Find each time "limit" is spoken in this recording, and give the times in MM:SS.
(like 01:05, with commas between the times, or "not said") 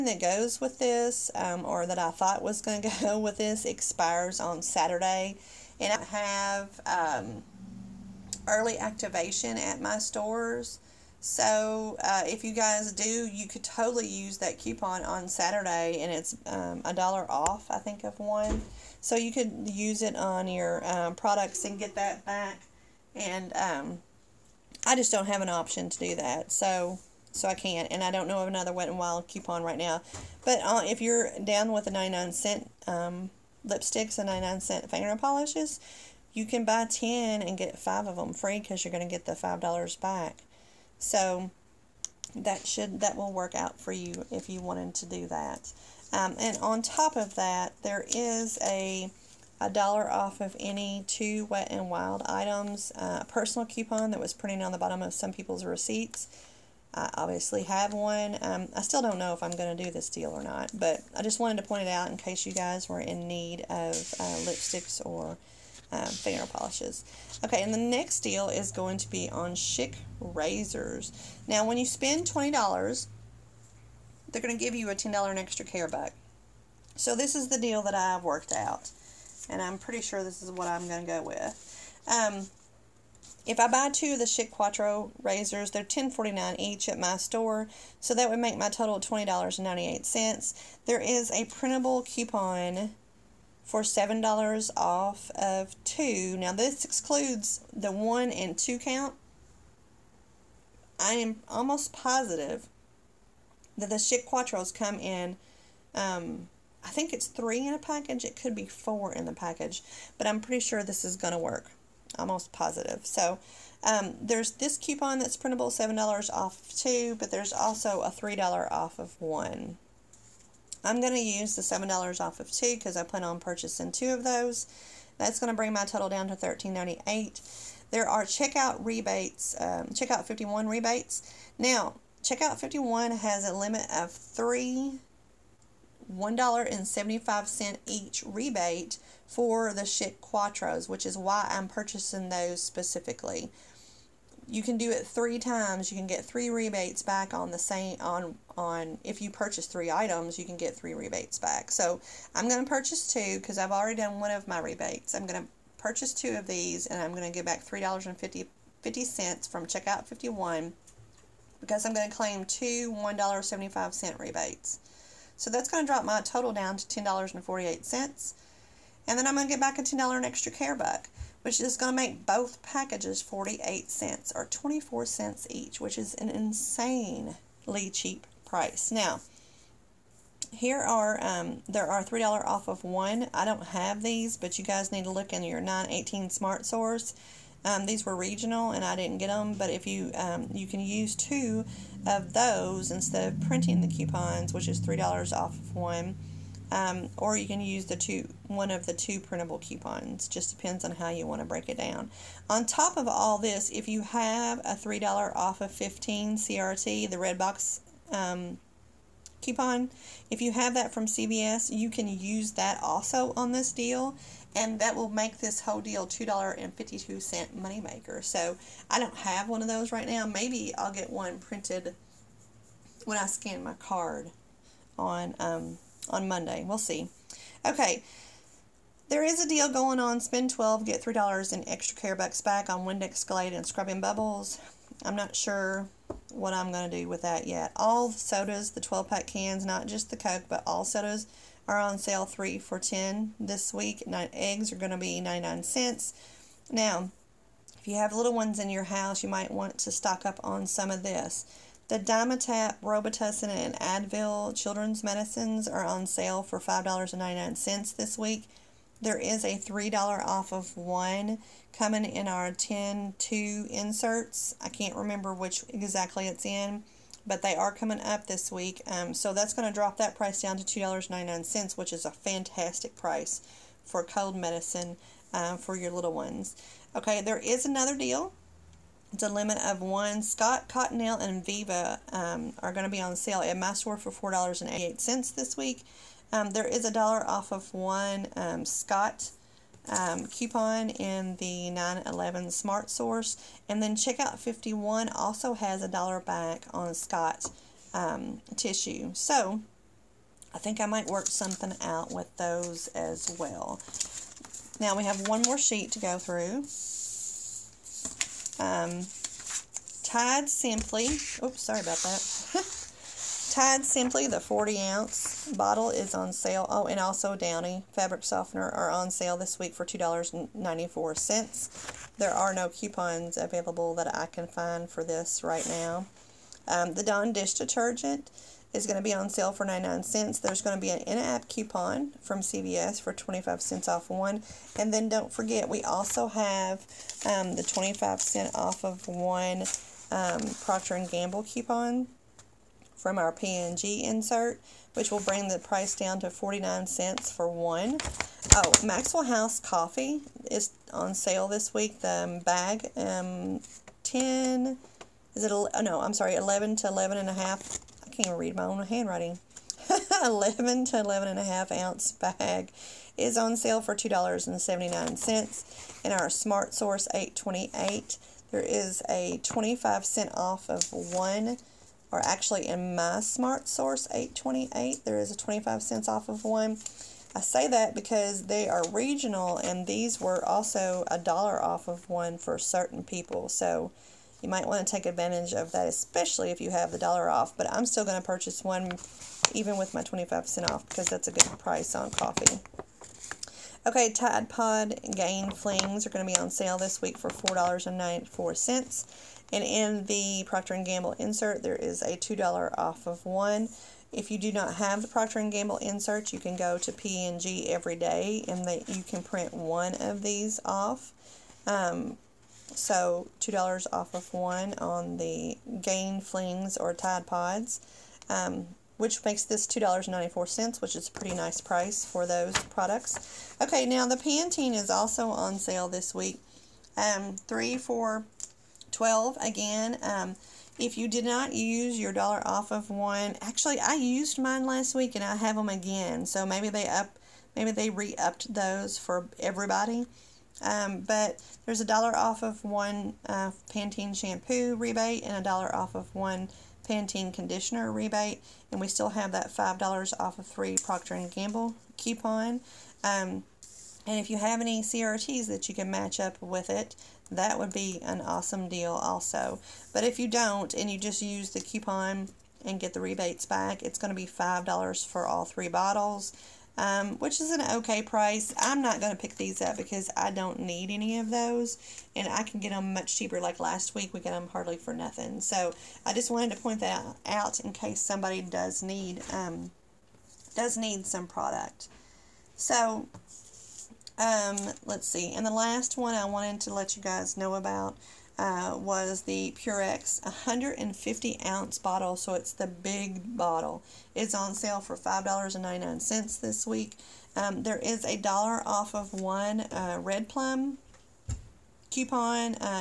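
02:13, 04:39.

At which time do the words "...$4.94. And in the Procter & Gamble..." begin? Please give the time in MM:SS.
06:37.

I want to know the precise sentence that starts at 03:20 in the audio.
Just depends on how you want to break it down.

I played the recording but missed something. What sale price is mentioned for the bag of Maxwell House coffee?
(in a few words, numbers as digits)
$2.79.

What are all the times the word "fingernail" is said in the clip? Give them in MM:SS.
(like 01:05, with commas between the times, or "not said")
00:34, 01:06.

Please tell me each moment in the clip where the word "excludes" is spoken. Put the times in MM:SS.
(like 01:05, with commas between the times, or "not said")
01:36.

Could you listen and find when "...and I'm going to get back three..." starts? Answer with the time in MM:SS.
02:36.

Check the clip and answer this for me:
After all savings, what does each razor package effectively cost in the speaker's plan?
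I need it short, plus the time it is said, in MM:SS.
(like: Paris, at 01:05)
24 cents, at 02:54.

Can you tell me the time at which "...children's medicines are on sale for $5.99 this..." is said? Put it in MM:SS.
04:14.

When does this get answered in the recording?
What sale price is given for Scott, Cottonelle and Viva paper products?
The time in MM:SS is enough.
04:44.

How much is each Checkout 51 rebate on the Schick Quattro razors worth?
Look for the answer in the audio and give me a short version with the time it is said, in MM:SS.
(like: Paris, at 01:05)
$1.75, at 02:16.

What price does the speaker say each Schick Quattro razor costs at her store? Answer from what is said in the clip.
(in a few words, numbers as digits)
$10.49.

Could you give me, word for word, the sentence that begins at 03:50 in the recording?
Spend 12, get $3 in extra care bucks back on Windex Glade and Scrubbing Bubbles.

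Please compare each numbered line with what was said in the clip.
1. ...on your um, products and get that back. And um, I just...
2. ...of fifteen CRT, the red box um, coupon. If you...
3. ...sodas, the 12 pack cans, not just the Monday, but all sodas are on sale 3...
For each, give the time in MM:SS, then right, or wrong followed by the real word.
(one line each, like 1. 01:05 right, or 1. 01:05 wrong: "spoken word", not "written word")
1. 00:20 right
2. 03:25 right
3. 03:58 wrong: "Coke", not "Monday".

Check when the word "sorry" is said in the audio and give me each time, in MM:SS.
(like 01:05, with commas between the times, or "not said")
05:11, 05:56.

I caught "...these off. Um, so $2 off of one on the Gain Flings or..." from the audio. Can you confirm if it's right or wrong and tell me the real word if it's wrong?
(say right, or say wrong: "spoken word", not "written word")
right.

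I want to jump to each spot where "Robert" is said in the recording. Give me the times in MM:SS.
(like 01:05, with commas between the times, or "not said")
not said.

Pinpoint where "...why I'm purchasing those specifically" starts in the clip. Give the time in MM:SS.
02:21.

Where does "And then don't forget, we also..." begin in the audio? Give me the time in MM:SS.
05:34.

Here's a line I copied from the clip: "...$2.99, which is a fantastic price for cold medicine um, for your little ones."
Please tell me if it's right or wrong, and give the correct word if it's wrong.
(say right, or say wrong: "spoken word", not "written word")
right.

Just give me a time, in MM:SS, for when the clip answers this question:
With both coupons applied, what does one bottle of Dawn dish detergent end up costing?
05:46.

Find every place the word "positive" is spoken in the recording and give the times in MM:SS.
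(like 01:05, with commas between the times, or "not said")
01:41, 01:52.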